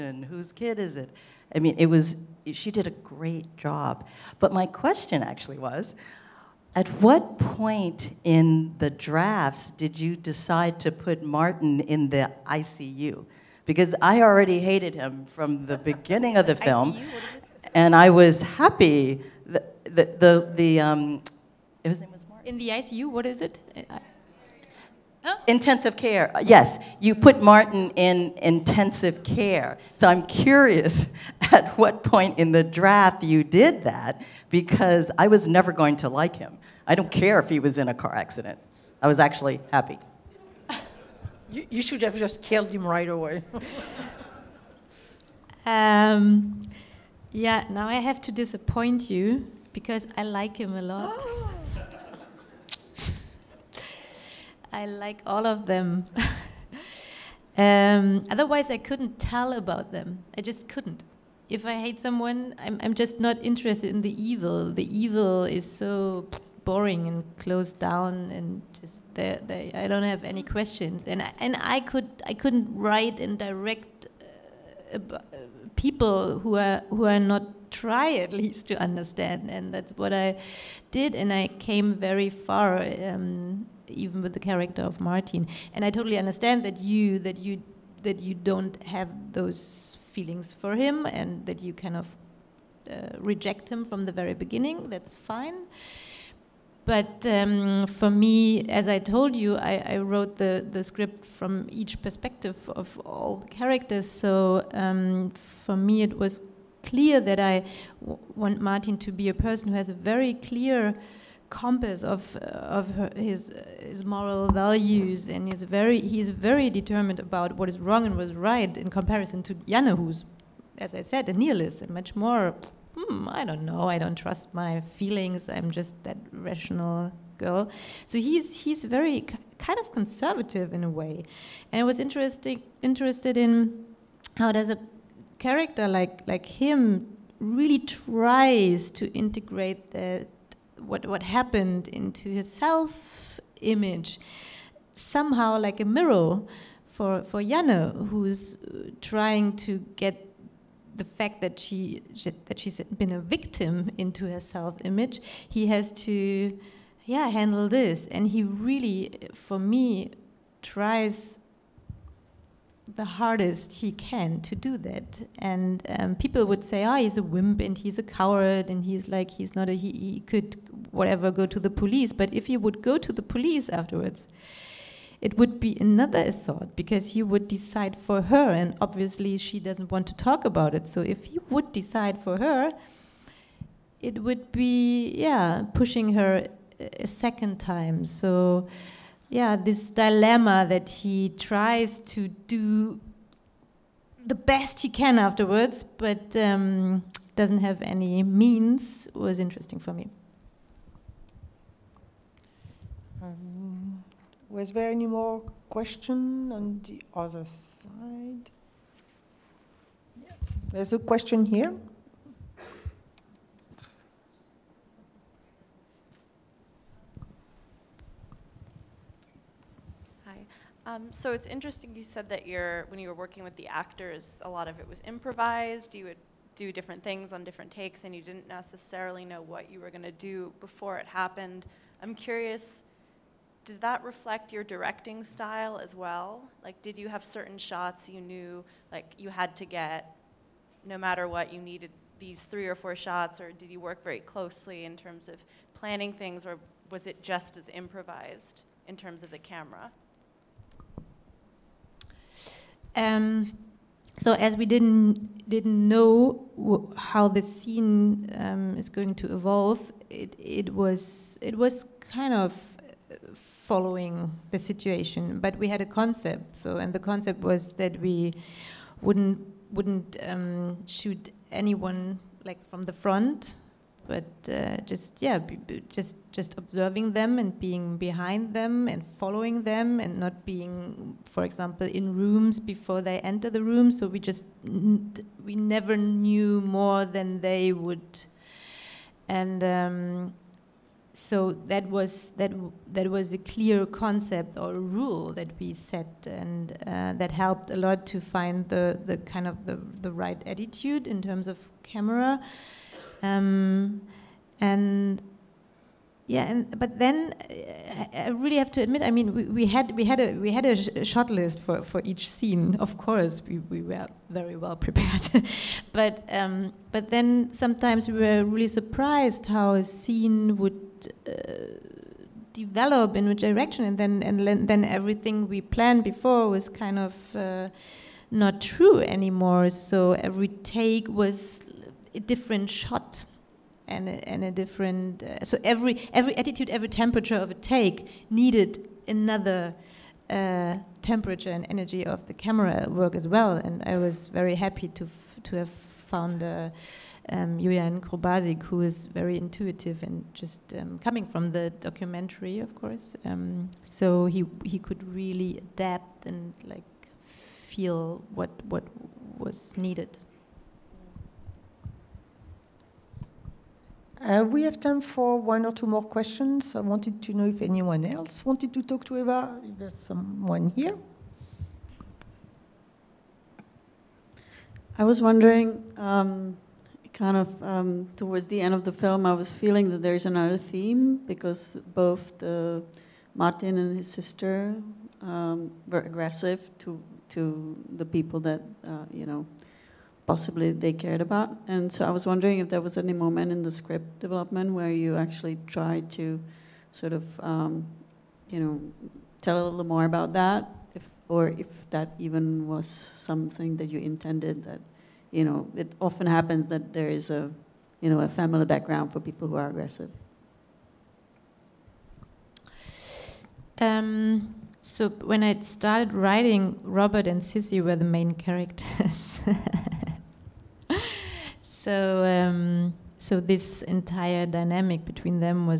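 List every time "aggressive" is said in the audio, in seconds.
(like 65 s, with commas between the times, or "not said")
386 s, 409 s.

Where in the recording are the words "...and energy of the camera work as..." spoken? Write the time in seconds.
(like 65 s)
341 s.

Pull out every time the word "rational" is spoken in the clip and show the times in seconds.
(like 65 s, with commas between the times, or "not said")
126 s.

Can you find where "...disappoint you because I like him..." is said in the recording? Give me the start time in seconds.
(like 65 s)
48 s.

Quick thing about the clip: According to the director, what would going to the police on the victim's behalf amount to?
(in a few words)
Another assault.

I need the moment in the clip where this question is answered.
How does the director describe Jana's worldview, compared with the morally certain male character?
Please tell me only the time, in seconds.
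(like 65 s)
121 s.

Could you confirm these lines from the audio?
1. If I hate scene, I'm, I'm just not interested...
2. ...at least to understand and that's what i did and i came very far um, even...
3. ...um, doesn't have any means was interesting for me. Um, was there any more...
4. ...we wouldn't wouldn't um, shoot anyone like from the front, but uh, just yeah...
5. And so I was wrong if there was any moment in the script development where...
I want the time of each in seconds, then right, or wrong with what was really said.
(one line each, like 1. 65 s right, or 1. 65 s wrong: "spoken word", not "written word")
1. 61 s wrong: "someone", not "scene"
2. 78 s right
3. 196 s right
4. 268 s right
5. 391 s wrong: "wondering", not "wrong".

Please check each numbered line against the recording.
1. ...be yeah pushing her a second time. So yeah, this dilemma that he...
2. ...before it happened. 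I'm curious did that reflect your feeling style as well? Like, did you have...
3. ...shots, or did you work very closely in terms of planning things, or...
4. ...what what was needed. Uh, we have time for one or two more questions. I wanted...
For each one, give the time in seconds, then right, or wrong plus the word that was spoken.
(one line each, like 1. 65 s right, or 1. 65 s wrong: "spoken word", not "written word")
1. 184 s right
2. 230 s wrong: "directing", not "feeling"
3. 242 s right
4. 358 s right.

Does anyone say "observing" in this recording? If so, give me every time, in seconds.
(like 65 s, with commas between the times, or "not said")
276 s.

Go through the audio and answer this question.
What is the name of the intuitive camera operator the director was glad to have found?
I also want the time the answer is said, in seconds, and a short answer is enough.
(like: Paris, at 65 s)
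Julian Krubasik, at 347 s.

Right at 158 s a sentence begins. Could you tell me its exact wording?
And he really, for me, tries the hardest he can to do that.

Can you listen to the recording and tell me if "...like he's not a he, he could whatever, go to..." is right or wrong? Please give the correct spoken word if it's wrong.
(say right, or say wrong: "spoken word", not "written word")
right.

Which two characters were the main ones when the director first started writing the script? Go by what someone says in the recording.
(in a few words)
Robert and Sissy.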